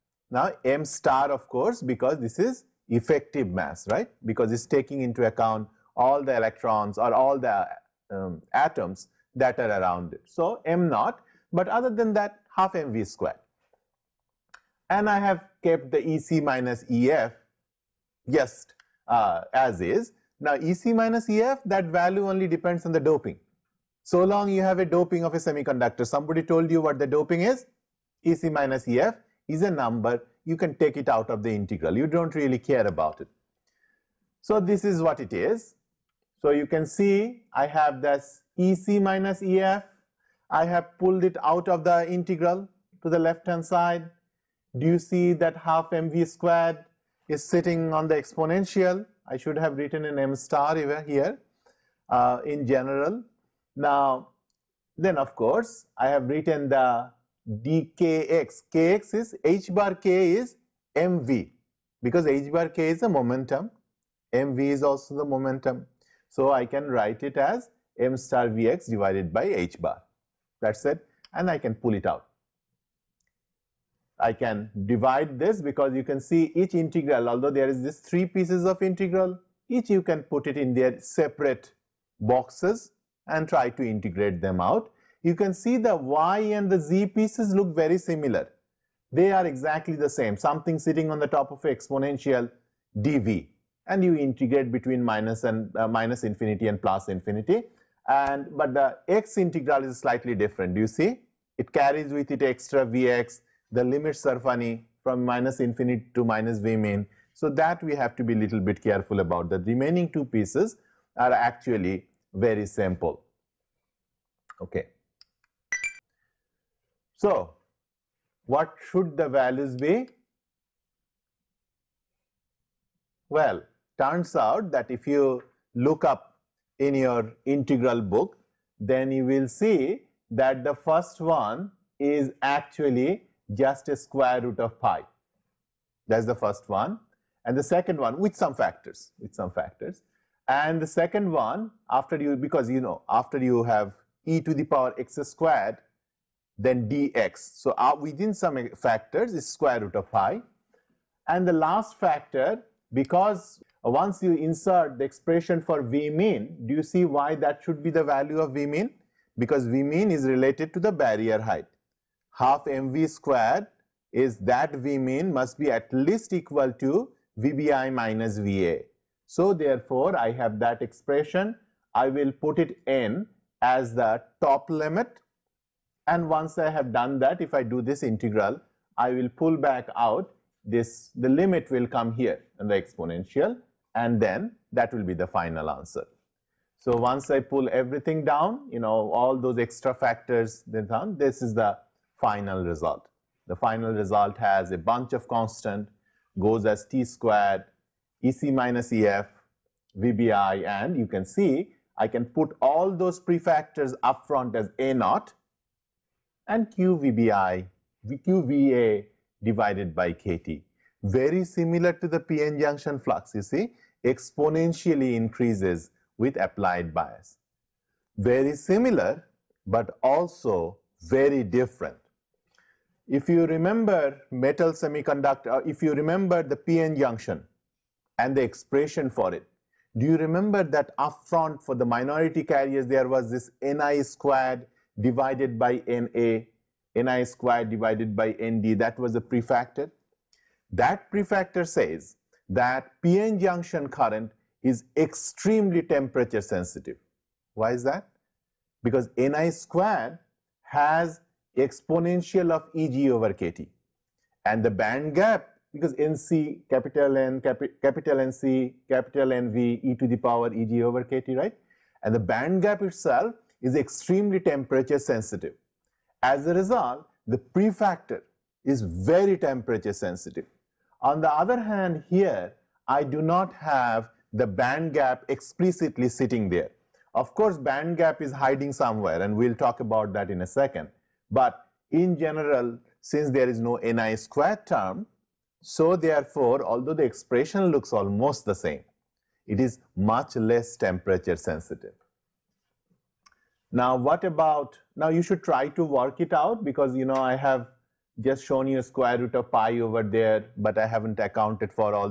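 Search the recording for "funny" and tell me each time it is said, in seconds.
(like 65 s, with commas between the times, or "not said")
104 s.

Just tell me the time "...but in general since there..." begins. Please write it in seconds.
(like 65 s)
281 s.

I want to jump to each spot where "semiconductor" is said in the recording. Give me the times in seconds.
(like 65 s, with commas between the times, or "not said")
25 s, 224 s.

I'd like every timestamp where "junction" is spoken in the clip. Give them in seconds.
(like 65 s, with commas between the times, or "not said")
212 s, 226 s, 243 s.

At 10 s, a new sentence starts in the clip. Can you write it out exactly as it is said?
So m naught, but other than that half mv squared.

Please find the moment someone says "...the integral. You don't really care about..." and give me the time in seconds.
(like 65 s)
31 s.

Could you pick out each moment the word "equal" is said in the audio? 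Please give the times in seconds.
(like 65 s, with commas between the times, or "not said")
166 s.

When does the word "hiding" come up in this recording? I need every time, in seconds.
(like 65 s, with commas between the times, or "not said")
278 s.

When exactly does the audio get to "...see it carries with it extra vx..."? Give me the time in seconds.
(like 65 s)
100 s.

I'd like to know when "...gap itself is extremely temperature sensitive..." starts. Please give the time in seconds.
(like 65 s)
262 s.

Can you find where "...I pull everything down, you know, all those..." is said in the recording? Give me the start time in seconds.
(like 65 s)
187 s.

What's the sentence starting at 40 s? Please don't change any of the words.
I have pulled it out of the integral to the left hand side.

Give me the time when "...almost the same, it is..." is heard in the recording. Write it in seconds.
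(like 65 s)
287 s.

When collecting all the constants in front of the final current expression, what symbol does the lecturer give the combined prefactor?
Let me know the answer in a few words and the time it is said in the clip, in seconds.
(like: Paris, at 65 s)
A naught, at 204 s.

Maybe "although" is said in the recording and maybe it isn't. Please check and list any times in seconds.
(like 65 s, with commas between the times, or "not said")
77 s, 286 s.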